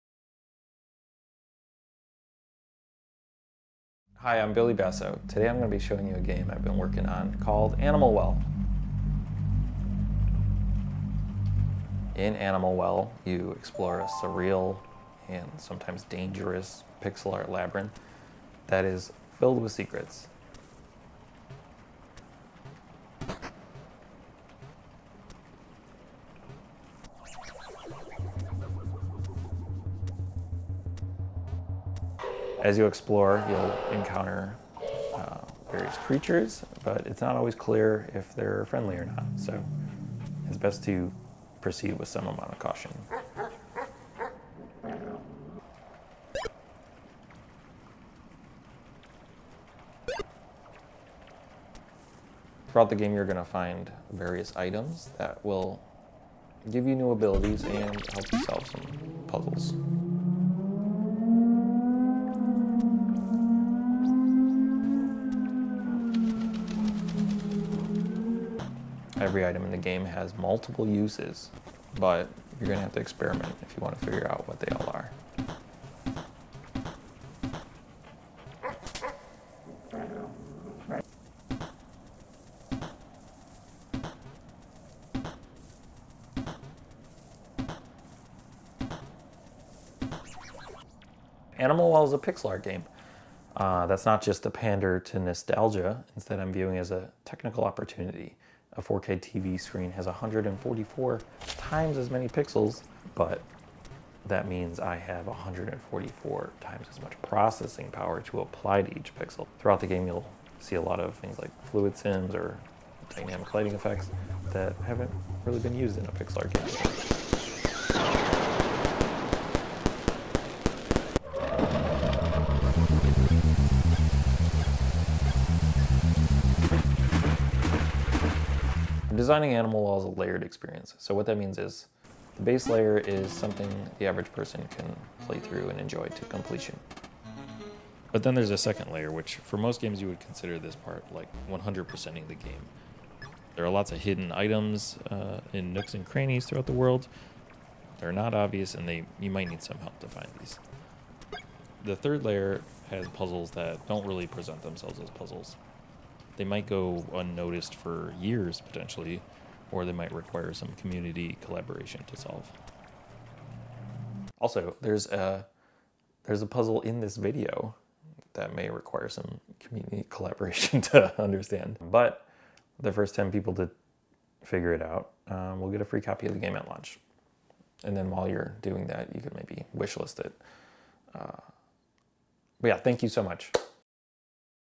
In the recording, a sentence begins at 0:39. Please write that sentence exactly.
So it's best to proceed with some amount of caution.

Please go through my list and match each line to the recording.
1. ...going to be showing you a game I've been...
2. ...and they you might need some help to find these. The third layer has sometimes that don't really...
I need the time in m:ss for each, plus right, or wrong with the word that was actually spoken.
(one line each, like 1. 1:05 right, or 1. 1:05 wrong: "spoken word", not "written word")
1. 0:05 right
2. 2:28 wrong: "puzzles", not "sometimes".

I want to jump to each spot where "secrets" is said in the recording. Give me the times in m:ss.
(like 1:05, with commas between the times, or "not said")
0:19.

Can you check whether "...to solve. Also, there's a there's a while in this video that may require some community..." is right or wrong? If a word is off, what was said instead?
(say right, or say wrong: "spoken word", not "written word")
wrong: "puzzle", not "while".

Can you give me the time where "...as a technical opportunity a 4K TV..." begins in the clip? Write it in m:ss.
1:36.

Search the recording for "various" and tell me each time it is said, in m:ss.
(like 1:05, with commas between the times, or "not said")
0:35, 0:54.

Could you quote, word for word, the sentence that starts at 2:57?
And then while you're doing that, you could maybe wishlist it.